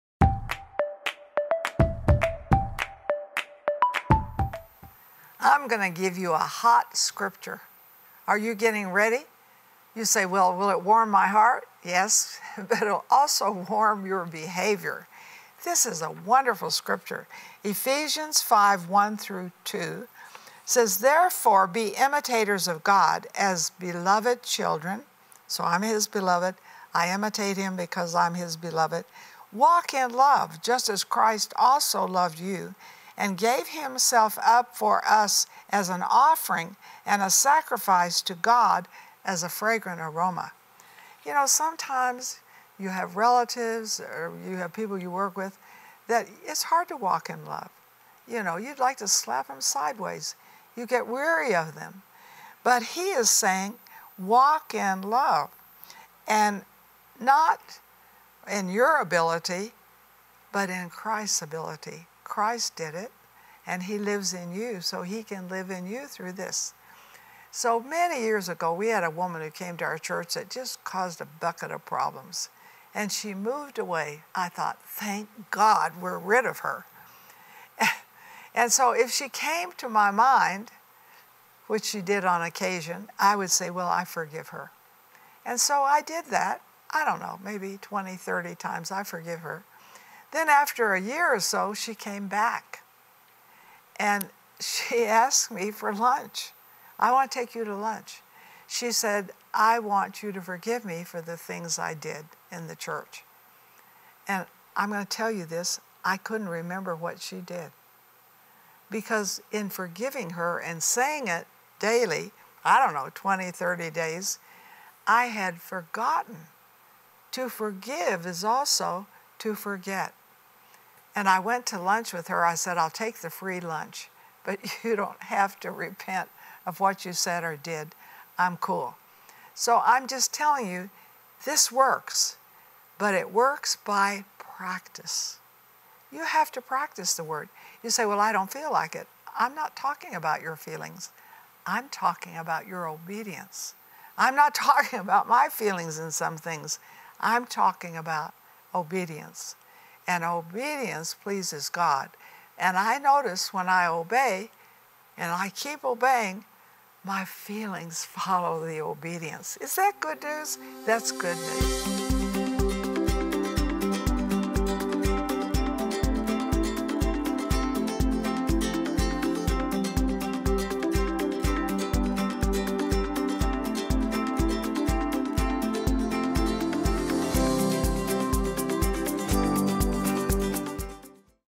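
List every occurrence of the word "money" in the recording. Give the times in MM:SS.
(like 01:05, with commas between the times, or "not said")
not said.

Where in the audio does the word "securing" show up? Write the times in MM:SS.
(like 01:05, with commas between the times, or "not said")
not said.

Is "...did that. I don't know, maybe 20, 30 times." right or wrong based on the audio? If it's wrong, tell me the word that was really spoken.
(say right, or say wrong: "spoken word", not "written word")
right.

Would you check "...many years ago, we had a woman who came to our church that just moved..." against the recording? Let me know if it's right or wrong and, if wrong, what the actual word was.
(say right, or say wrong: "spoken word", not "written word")
wrong: "caused", not "moved".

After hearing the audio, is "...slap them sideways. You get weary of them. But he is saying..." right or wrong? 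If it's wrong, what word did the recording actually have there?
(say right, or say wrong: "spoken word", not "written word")
right.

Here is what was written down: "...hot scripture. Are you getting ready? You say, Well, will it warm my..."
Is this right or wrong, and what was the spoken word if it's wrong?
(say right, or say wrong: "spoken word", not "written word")
right.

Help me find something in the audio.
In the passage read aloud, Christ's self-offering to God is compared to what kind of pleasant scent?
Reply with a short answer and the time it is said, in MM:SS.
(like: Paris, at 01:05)
a fragrant aroma, at 00:39.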